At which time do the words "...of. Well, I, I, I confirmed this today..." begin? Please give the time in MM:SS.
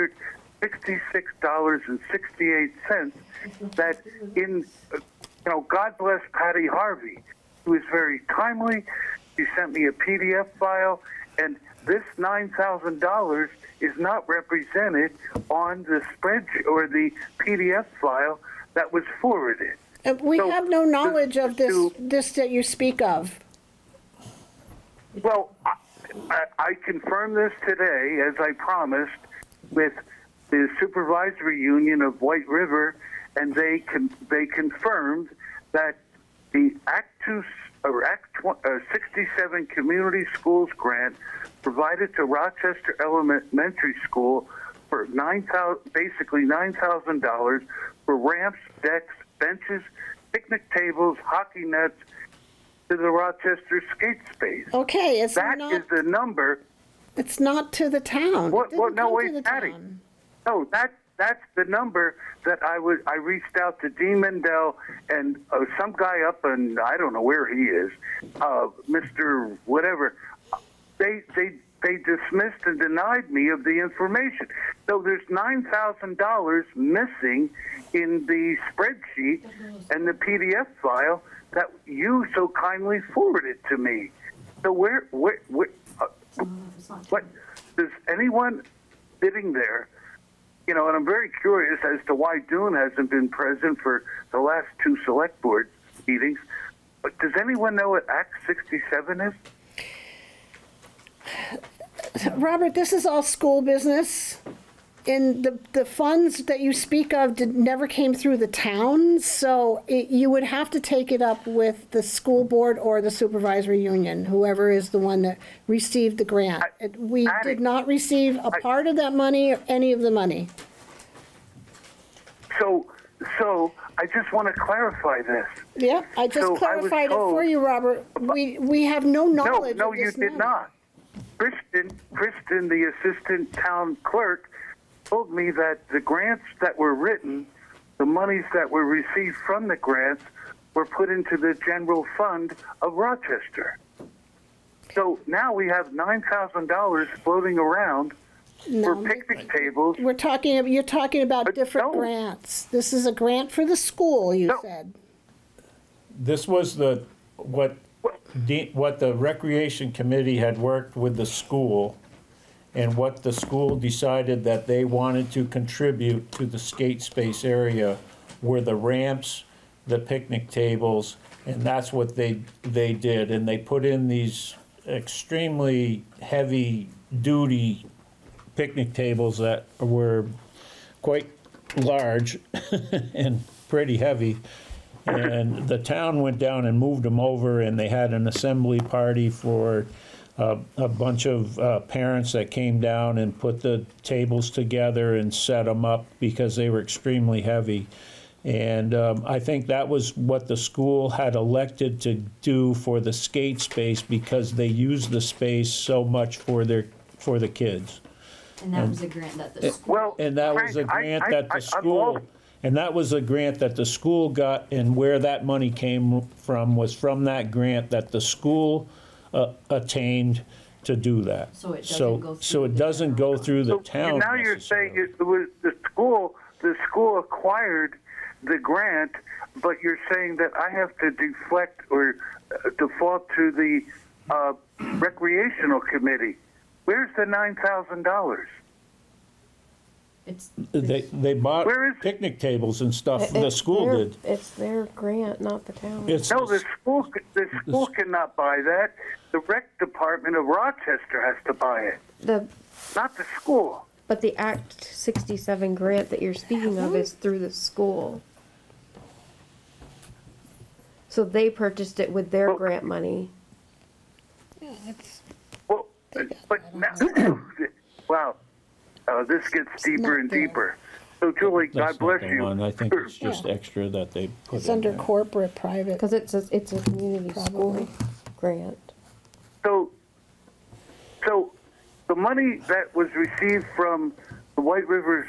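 00:22.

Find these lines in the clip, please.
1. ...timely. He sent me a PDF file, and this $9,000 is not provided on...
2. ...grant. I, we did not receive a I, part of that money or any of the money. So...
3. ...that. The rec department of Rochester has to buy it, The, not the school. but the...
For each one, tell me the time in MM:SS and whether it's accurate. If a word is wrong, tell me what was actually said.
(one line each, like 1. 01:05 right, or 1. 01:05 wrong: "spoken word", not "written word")
1. 00:08 wrong: "represented", not "provided"
2. 01:56 right
3. 04:08 right.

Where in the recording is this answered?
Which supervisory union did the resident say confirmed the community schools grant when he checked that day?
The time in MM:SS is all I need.
00:30.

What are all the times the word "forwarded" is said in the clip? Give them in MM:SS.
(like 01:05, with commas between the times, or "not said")
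00:19, 01:23.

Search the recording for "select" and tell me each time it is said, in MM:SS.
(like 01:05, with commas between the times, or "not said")
01:35.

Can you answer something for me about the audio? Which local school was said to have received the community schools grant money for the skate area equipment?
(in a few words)
Rochester Elementary School.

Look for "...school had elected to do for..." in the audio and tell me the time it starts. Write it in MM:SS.
03:20.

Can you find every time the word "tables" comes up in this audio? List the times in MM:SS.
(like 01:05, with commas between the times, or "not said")
00:50, 02:29, 02:50, 02:58, 03:14, 04:02.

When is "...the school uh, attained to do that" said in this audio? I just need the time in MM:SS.
03:38.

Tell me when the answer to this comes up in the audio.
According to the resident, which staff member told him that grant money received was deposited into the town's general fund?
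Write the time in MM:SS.
02:12.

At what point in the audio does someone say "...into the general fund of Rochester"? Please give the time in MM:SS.
02:21.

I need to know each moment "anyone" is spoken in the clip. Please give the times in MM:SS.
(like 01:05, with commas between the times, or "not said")
01:28, 01:37.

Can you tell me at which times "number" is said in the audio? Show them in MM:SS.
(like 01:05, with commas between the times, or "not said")
00:56, 01:01.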